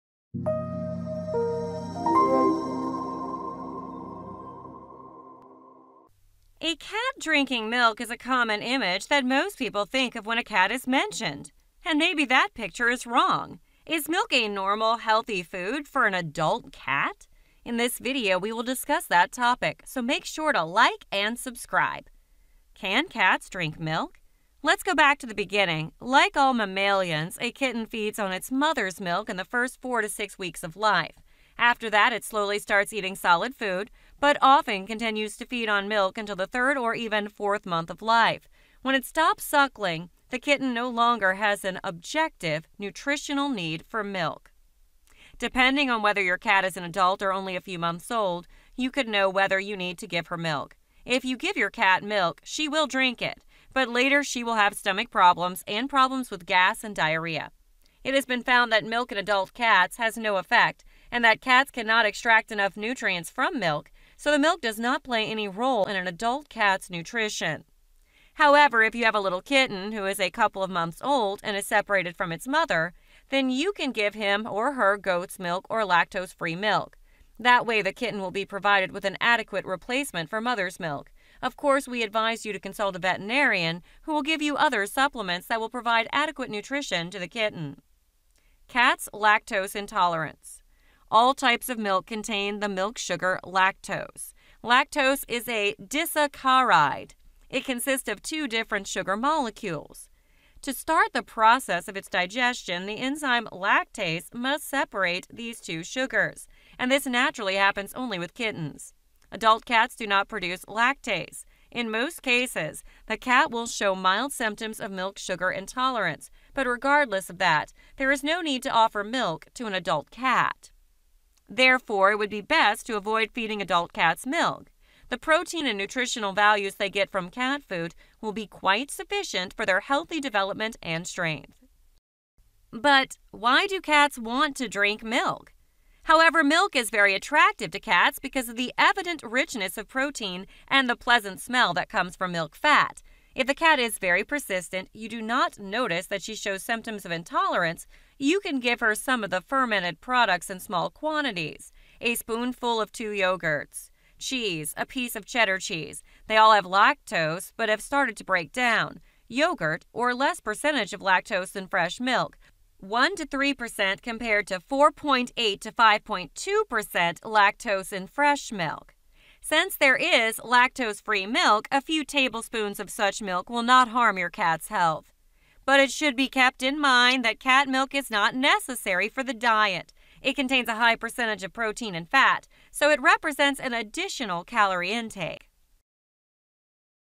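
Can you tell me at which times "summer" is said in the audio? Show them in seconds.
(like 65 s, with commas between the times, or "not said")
not said.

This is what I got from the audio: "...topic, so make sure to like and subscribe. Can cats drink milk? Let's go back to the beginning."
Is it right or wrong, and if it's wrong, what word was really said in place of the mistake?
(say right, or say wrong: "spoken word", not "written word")
right.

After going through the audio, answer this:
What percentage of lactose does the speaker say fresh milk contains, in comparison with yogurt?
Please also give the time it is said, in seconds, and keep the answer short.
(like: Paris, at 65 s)
4.8 to 5.2%, at 164 s.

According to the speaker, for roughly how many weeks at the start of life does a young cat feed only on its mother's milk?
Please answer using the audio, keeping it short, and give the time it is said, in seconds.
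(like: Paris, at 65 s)
4 to 6 weeks, at 29 s.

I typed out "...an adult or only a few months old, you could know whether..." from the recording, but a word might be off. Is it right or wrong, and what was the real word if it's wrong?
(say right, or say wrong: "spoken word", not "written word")
right.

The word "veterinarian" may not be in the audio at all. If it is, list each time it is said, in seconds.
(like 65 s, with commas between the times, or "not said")
82 s.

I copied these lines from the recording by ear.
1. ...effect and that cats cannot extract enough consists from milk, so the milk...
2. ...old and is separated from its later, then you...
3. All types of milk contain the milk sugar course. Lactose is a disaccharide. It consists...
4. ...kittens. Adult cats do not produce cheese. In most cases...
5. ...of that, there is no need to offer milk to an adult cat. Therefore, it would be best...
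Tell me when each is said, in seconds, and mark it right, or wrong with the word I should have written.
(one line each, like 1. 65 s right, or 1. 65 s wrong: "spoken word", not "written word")
1. 60 s wrong: "nutrients", not "consists"
2. 71 s wrong: "mother", not "later"
3. 91 s wrong: "lactose", not "course"
4. 108 s wrong: "lactase", not "cheese"
5. 117 s right.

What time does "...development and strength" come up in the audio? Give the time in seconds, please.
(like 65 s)
130 s.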